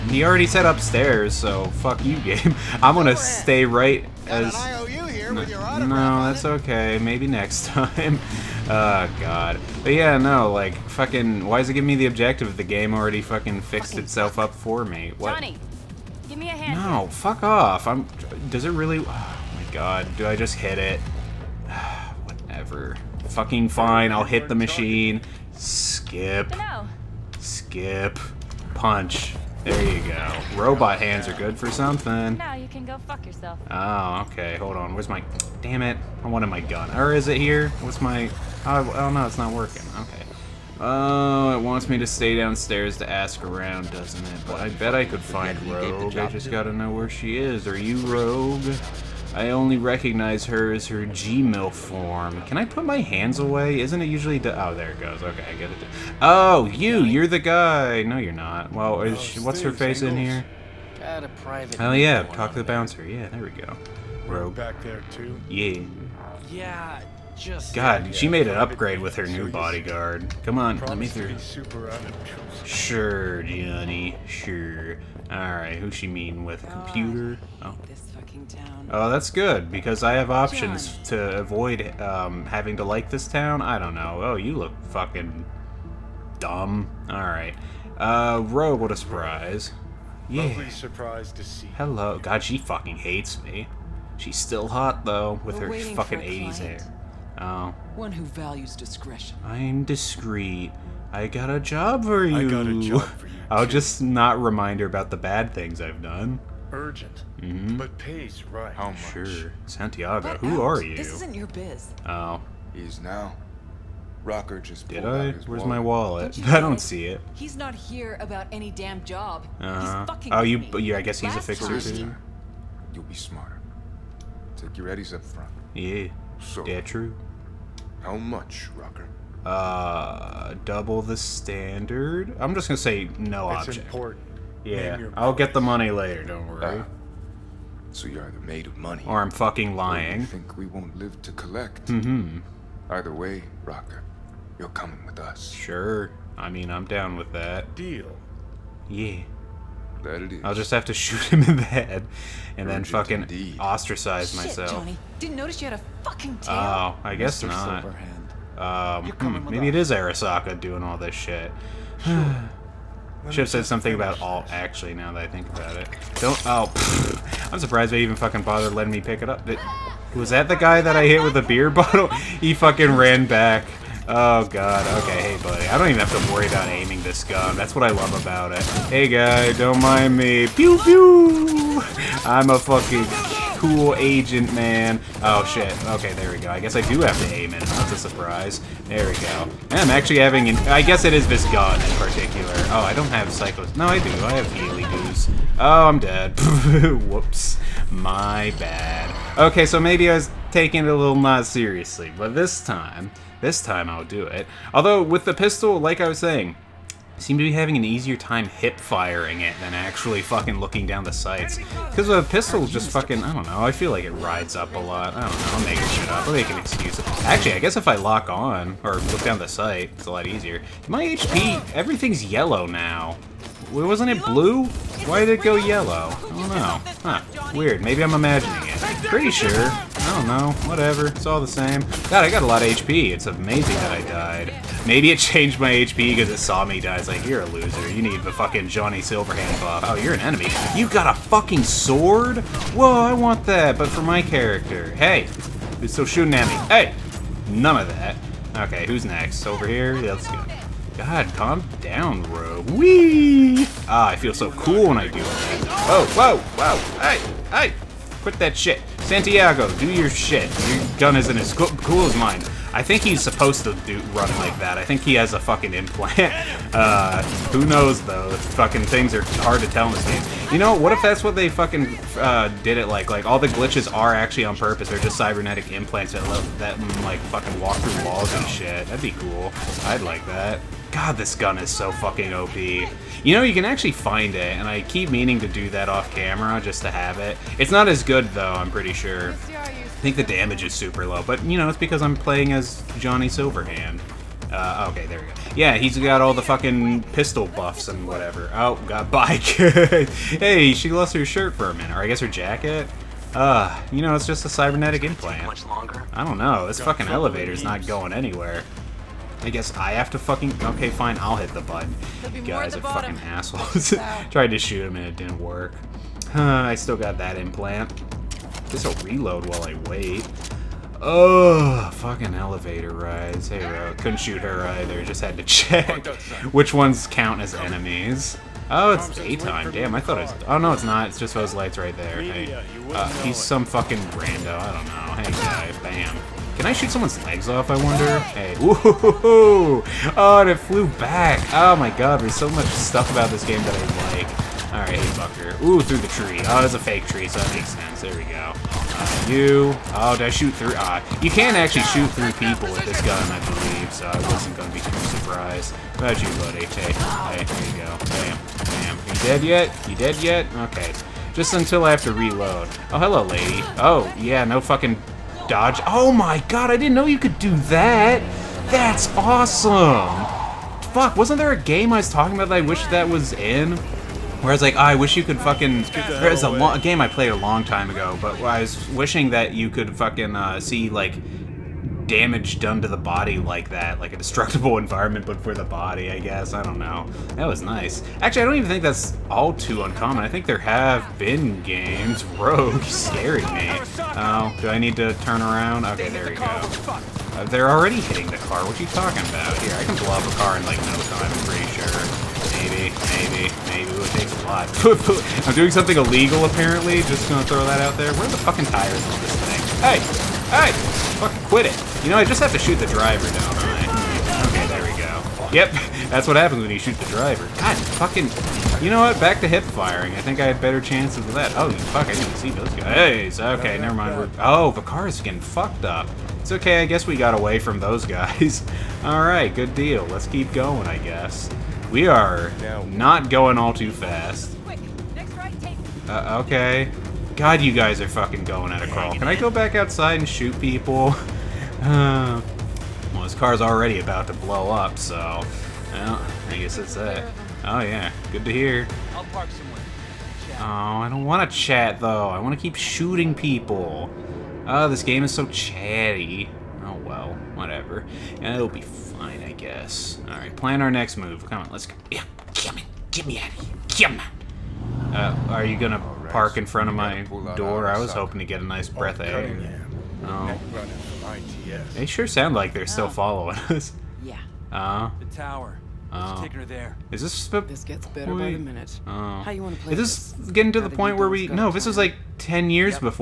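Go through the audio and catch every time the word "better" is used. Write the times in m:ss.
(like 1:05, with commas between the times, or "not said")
7:00, 7:58.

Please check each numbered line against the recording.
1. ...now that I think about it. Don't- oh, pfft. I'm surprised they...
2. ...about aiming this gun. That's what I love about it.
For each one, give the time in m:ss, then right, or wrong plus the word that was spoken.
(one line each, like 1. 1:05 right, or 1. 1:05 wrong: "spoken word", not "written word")
1. 2:44 right
2. 2:56 right.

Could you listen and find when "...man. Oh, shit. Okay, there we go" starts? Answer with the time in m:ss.
3:04.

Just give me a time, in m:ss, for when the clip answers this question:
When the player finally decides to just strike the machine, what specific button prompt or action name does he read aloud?
0:27.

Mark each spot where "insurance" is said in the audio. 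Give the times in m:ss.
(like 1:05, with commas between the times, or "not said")
not said.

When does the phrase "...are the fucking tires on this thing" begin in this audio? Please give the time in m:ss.
6:48.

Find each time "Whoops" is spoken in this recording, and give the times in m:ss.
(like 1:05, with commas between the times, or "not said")
3:17.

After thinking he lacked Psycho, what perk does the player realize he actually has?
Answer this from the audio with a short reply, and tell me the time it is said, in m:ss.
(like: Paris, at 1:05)
Healy Goose, at 3:14.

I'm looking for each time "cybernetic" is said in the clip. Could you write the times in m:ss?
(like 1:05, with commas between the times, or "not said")
4:35, 5:04.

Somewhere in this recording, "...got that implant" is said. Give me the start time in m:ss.
5:16.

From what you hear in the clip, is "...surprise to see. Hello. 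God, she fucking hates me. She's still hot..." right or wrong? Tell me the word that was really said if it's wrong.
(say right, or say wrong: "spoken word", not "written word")
right.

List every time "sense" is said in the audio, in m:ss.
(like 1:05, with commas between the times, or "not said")
5:47.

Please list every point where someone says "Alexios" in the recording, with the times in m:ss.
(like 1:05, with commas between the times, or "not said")
not said.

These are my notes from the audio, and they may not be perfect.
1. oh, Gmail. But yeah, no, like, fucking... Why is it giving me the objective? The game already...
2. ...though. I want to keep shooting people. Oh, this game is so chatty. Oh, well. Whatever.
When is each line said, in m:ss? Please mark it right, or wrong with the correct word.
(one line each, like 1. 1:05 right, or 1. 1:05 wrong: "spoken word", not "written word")
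1. 0:08 wrong: "God", not "Gmail"
2. 7:31 right.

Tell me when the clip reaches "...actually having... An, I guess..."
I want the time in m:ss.
3:09.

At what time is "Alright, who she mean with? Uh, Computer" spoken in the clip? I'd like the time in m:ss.
1:15.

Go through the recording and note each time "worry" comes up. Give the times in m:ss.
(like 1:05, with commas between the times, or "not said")
2:16, 2:56.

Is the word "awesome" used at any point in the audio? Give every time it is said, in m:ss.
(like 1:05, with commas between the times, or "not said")
6:09.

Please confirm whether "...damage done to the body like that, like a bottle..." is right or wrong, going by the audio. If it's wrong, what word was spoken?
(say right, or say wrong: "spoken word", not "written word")
wrong: "destructible", not "bottle".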